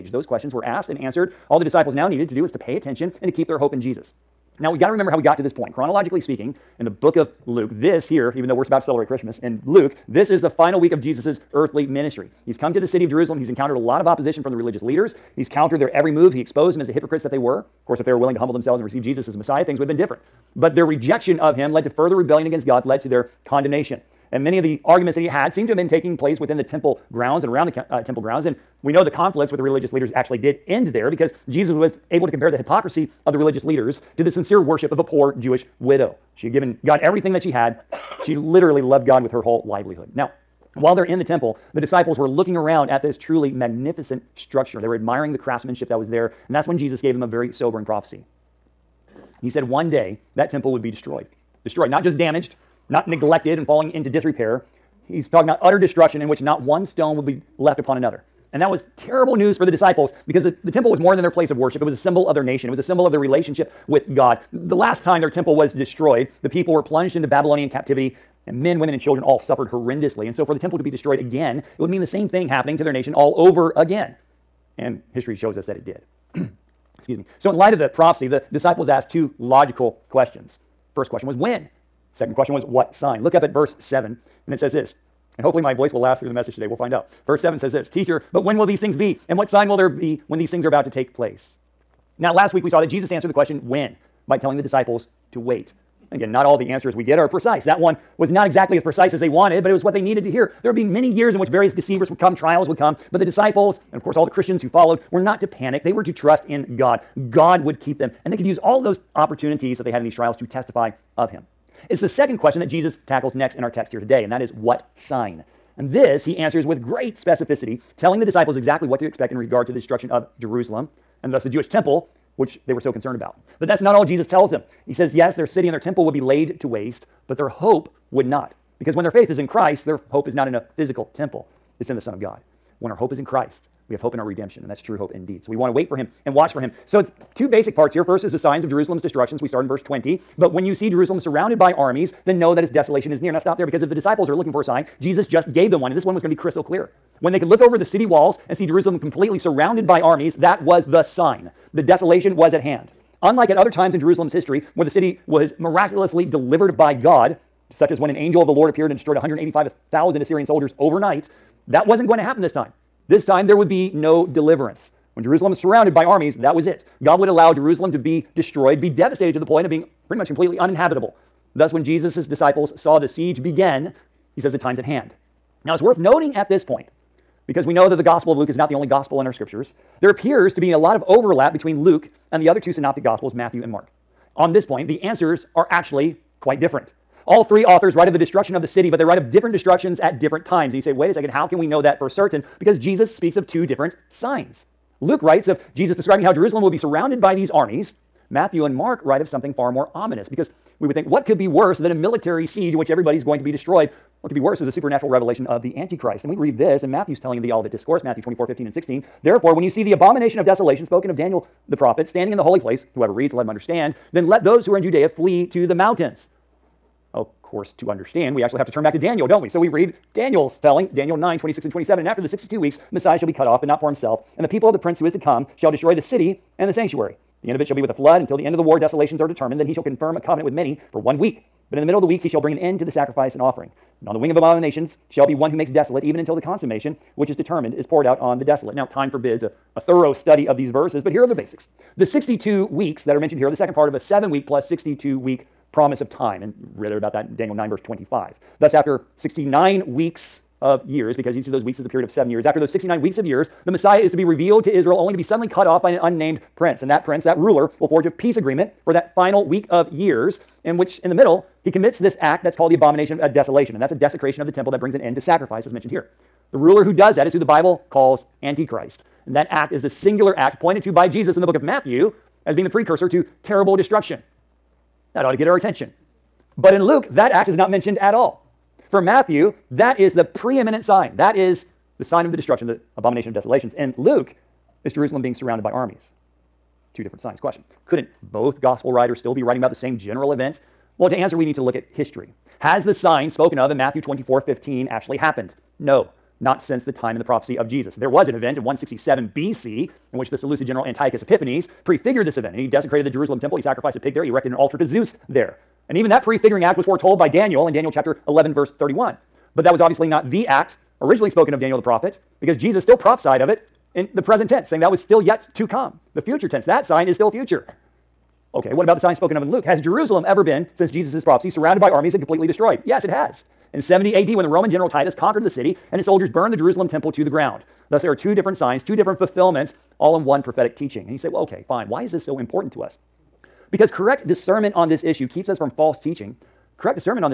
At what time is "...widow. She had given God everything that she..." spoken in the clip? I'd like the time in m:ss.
0:35.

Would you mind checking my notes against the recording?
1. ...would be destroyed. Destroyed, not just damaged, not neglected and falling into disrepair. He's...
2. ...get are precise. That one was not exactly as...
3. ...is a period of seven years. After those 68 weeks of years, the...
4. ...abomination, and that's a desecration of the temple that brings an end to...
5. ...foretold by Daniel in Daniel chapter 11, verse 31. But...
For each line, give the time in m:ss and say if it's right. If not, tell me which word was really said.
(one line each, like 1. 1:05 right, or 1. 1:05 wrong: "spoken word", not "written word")
1. 0:50 right
2. 1:37 right
3. 4:11 wrong: "69", not "68"
4. 4:23 wrong: "desolation", not "abomination"
5. 5:06 right.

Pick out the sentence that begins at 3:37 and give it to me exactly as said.
Of course, to understand, we actually have to turn back to Daniel, don't we?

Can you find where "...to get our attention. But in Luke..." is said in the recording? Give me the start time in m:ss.
4:35.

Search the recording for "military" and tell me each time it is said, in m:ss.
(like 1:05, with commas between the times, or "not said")
3:21.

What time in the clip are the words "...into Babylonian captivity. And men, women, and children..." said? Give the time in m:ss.
1:07.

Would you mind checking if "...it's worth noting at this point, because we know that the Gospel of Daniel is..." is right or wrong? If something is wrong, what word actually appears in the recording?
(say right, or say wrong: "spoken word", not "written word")
wrong: "Luke", not "Daniel".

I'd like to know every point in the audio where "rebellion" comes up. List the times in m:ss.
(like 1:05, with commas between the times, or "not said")
0:22.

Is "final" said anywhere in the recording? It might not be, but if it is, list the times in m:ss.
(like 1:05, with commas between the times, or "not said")
0:10, 4:19.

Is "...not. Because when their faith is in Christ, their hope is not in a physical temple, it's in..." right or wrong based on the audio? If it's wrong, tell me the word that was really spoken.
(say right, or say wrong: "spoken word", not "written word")
right.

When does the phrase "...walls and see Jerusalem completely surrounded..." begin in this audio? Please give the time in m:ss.
2:28.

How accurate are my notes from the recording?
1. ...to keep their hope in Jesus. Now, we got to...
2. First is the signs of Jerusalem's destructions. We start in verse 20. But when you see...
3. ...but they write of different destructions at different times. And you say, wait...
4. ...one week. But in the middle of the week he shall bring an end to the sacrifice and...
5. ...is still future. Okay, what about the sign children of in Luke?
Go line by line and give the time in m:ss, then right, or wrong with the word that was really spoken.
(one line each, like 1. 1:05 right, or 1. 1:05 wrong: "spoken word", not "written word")
1. 0:03 right
2. 2:18 right
3. 3:08 right
4. 3:50 right
5. 5:17 wrong: "spoken", not "children".